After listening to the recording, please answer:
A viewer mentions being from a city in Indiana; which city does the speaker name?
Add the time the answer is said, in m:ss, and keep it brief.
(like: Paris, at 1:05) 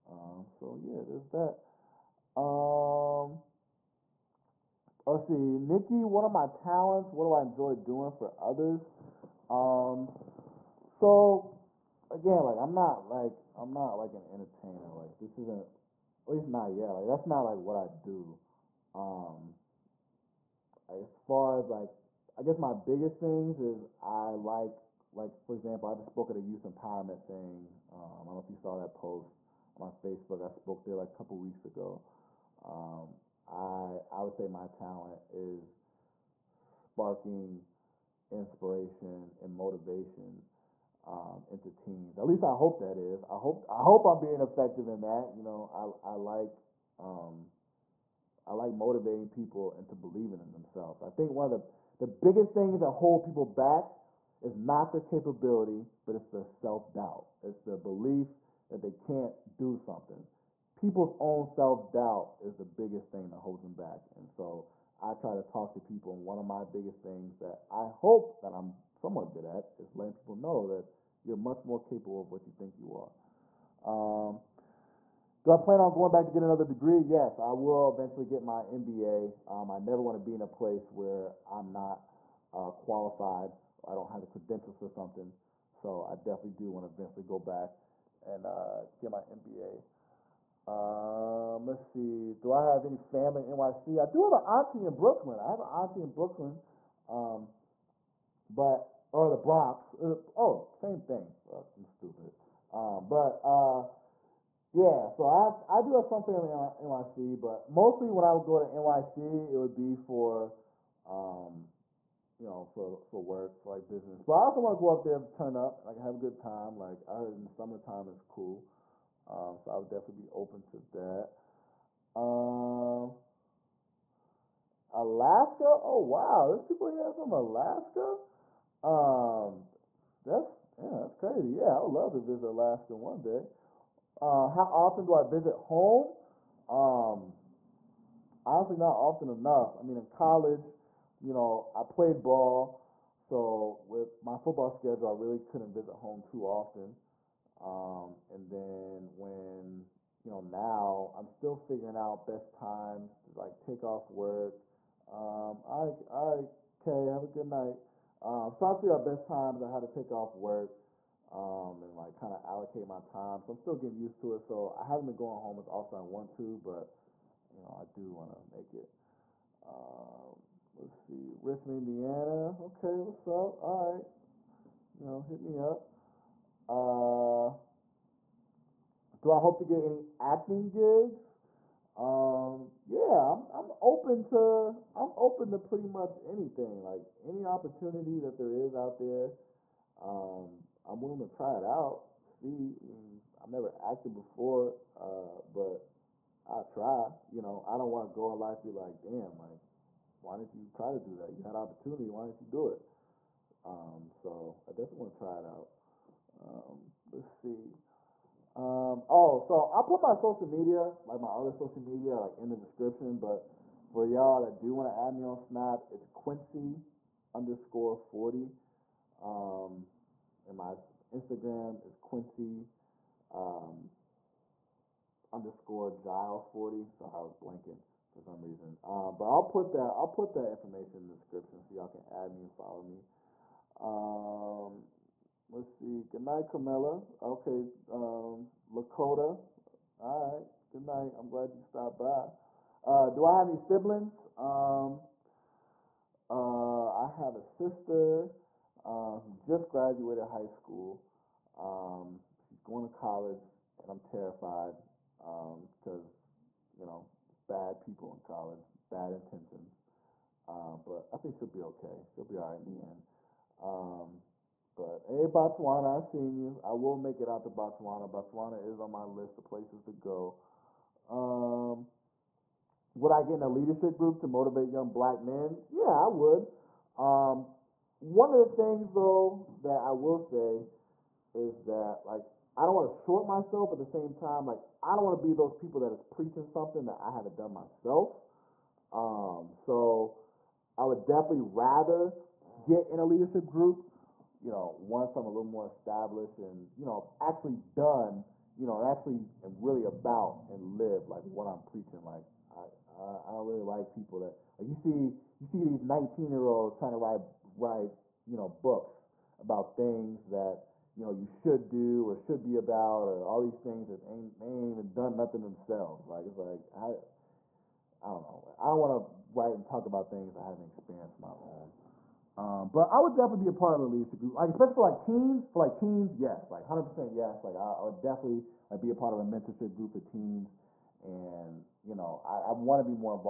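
Richmond, at 2:51.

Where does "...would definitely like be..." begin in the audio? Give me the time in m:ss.
5:27.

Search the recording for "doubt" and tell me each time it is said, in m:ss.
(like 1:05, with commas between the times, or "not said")
0:56, 1:01.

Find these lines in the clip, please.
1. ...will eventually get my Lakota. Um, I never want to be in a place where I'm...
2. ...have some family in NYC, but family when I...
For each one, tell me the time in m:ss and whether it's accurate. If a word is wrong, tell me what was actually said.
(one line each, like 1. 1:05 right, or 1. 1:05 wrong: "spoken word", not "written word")
1. 1:17 wrong: "MBA", not "Lakota"
2. 1:45 wrong: "mostly", not "family".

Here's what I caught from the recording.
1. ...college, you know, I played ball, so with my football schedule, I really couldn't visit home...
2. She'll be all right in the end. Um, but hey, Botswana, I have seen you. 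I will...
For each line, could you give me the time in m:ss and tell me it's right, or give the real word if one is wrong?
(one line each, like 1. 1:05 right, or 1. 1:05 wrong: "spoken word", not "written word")
1. 2:20 right
2. 4:22 right.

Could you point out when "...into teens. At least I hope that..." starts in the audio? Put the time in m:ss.
0:41.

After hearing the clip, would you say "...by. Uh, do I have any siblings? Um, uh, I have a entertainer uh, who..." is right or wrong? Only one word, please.
wrong.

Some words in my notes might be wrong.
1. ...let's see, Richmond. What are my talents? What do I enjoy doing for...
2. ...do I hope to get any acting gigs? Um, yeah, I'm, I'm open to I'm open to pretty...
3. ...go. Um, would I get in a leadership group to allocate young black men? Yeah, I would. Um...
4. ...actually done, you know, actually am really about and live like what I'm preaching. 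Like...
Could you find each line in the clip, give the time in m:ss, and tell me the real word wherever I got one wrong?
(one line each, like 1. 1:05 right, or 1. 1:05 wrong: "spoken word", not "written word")
1. 0:05 wrong: "Nikki", not "Richmond"
2. 2:59 right
3. 4:29 wrong: "motivate", not "allocate"
4. 4:57 right.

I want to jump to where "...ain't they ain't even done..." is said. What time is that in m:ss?
5:14.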